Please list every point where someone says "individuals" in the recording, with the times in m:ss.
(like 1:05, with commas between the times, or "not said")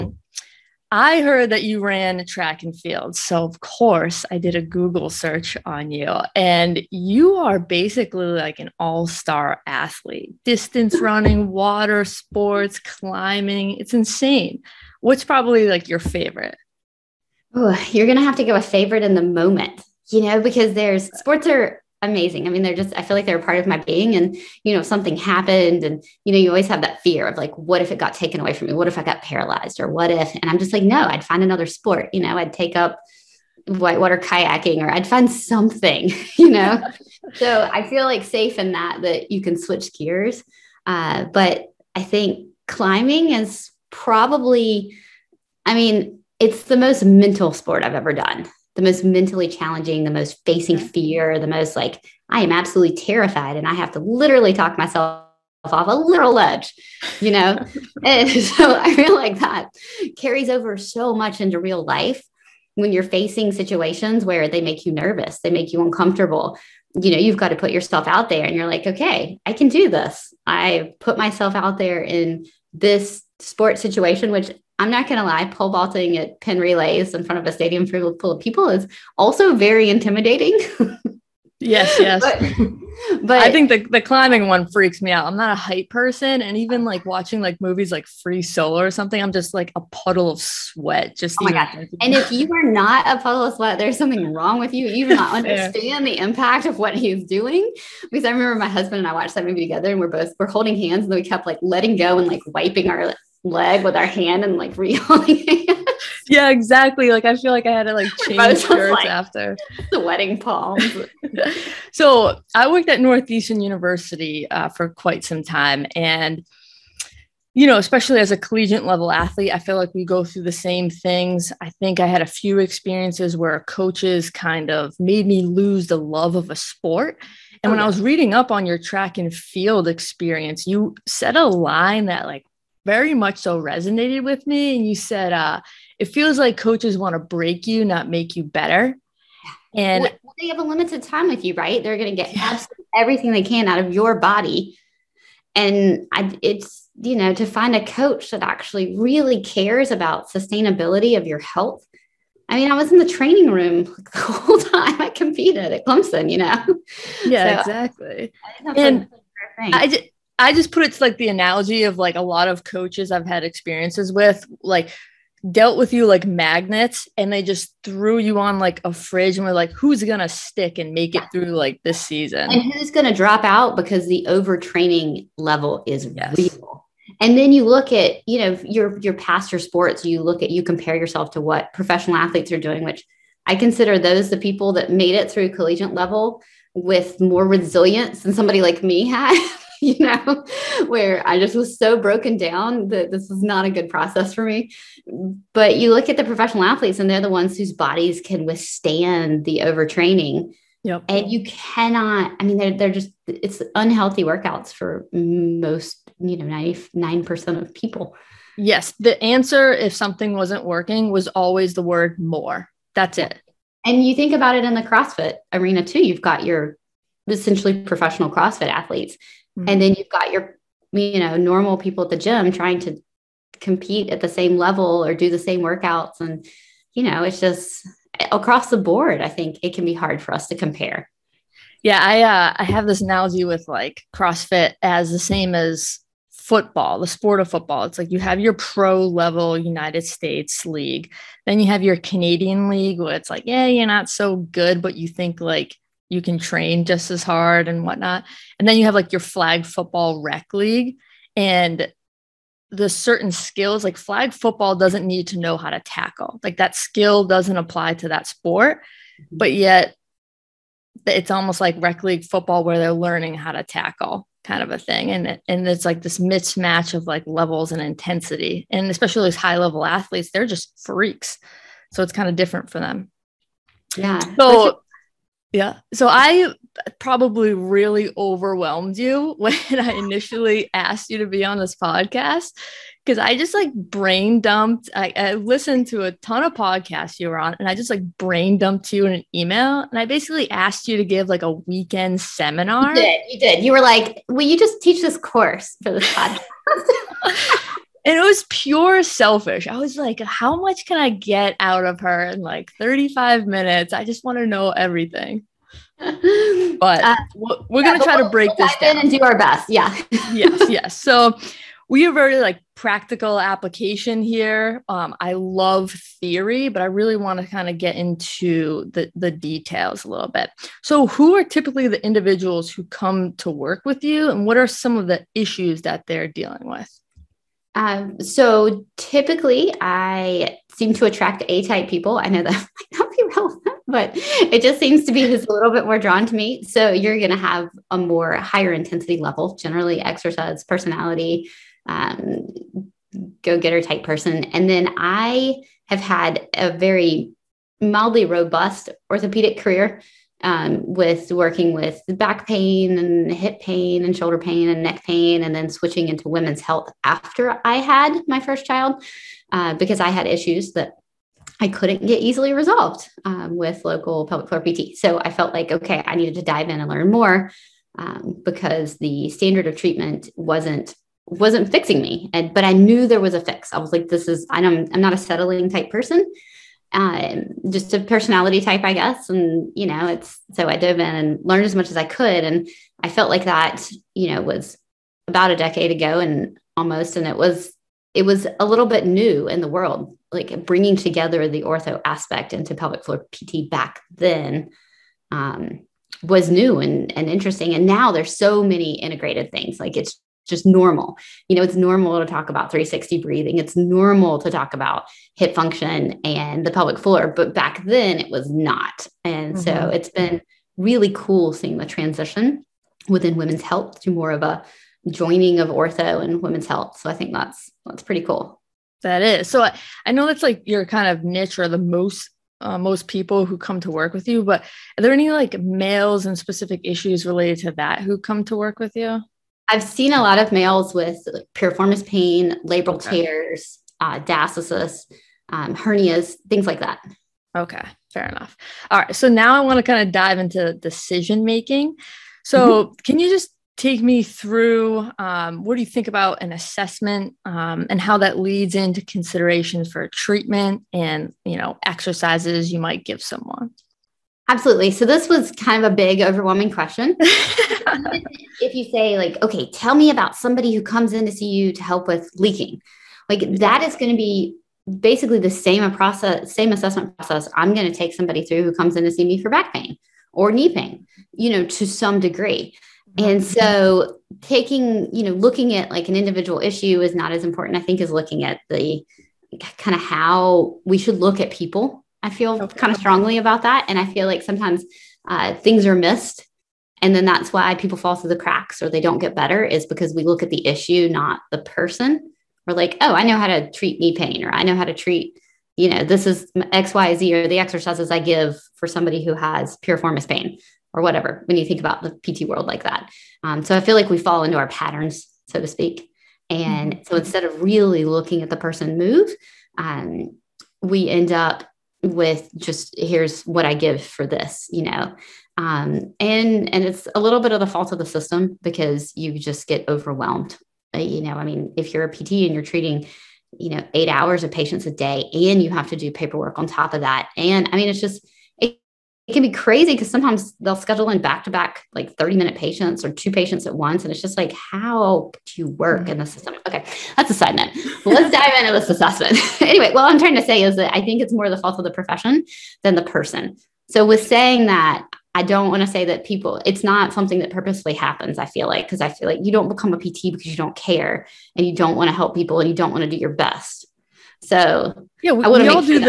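5:22, 7:56.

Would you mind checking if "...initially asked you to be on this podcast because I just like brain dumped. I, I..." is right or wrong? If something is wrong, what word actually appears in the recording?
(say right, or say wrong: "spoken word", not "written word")
right.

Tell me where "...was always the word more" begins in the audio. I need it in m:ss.
3:31.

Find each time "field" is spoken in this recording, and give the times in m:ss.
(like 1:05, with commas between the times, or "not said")
0:02, 2:09.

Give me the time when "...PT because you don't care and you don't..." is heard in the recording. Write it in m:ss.
9:09.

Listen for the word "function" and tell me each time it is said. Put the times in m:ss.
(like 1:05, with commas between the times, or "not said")
6:45.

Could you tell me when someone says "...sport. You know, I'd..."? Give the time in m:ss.
0:31.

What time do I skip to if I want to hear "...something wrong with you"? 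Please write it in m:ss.
1:33.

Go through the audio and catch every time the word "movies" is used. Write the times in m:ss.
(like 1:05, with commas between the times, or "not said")
1:27, 1:39.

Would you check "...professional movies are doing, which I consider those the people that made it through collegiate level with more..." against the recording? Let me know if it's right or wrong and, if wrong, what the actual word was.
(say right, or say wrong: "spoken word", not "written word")
wrong: "athletes", not "movies".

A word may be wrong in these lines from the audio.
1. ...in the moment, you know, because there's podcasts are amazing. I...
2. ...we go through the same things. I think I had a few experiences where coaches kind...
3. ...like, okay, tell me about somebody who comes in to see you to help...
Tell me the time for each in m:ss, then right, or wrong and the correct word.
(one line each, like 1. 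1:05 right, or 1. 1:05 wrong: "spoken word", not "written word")
1. 0:19 wrong: "sports", not "podcasts"
2. 1:59 right
3. 7:39 right.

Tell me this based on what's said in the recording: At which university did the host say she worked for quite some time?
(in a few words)
Northeastern University.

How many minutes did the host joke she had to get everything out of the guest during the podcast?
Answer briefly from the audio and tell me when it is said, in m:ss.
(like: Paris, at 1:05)
35, at 5:02.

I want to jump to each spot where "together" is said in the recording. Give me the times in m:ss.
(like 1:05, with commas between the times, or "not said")
1:39, 6:30.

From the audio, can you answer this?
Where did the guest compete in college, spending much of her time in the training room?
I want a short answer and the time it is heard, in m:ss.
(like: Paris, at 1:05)
Clemson, at 2:35.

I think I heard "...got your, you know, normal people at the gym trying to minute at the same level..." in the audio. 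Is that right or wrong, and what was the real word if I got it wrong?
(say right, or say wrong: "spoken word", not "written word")
wrong: "compete", not "minute".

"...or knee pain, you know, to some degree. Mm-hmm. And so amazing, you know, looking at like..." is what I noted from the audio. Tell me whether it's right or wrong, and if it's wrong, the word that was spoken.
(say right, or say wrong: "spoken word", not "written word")
wrong: "taking", not "amazing".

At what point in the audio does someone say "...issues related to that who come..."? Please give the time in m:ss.
7:06.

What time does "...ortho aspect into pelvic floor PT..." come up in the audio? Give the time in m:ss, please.
6:31.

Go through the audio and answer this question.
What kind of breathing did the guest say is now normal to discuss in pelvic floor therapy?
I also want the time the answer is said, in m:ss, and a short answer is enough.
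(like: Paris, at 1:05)
360 breathing, at 6:42.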